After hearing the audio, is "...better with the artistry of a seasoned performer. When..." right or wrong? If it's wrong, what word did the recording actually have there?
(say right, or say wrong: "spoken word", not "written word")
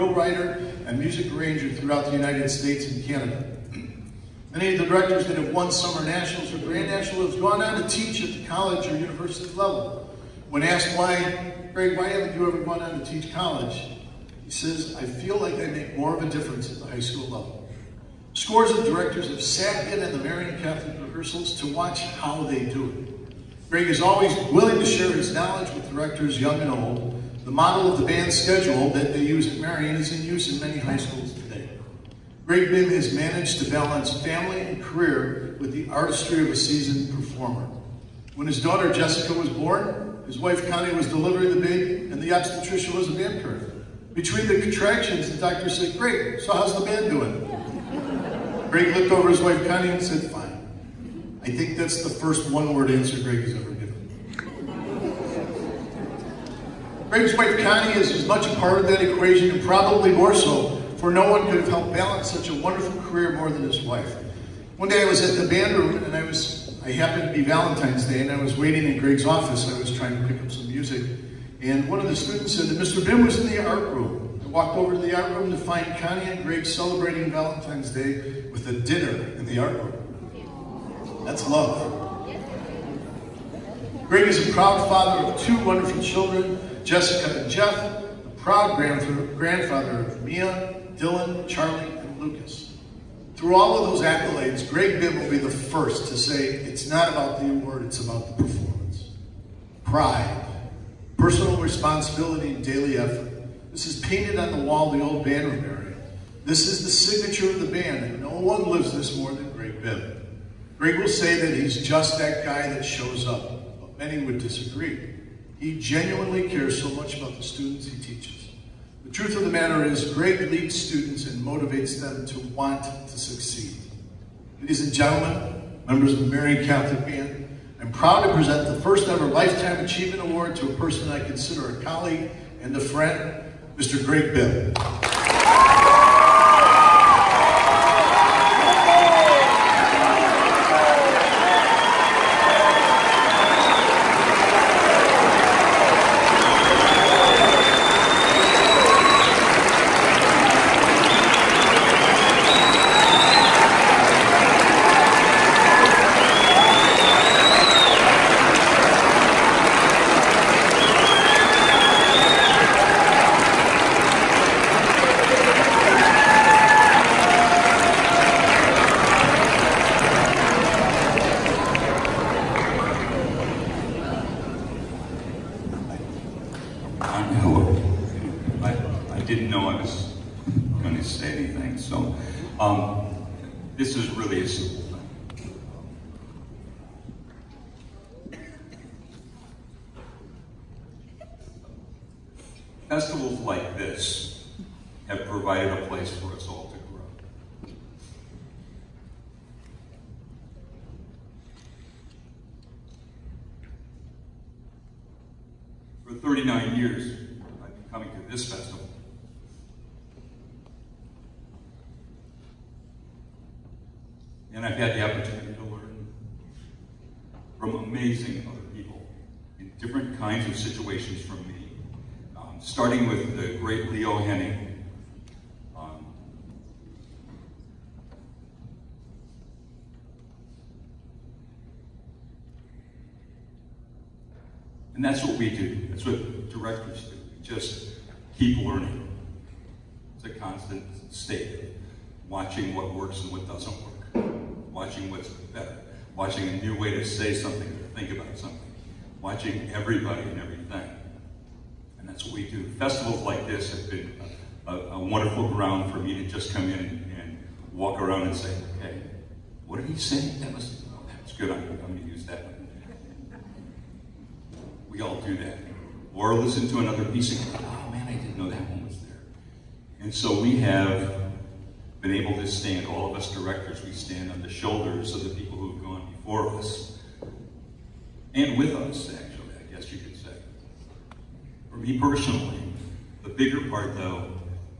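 wrong: "career", not "better".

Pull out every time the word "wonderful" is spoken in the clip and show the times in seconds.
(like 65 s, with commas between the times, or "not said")
62 s, 85 s, 254 s.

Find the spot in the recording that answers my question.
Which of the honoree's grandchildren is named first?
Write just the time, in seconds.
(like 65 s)
90 s.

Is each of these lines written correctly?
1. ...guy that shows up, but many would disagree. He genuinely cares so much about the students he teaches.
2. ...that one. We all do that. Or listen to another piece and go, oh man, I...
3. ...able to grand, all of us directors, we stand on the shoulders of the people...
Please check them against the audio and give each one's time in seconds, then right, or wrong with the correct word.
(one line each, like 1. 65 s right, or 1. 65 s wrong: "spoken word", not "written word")
1. 112 s right
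2. 262 s right
3. 272 s wrong: "stand", not "grand".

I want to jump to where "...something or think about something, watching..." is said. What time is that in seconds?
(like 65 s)
247 s.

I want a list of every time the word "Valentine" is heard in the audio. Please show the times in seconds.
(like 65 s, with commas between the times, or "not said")
67 s, 77 s.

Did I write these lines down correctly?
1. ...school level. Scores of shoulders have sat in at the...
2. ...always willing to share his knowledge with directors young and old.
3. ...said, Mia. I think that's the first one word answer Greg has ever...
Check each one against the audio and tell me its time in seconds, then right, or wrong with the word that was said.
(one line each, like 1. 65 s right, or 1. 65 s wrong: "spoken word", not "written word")
1. 16 s wrong: "directors", not "shoulders"
2. 24 s right
3. 50 s wrong: "Fine", not "Mia".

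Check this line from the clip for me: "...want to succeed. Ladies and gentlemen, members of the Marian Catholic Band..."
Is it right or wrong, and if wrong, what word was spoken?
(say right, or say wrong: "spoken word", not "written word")
right.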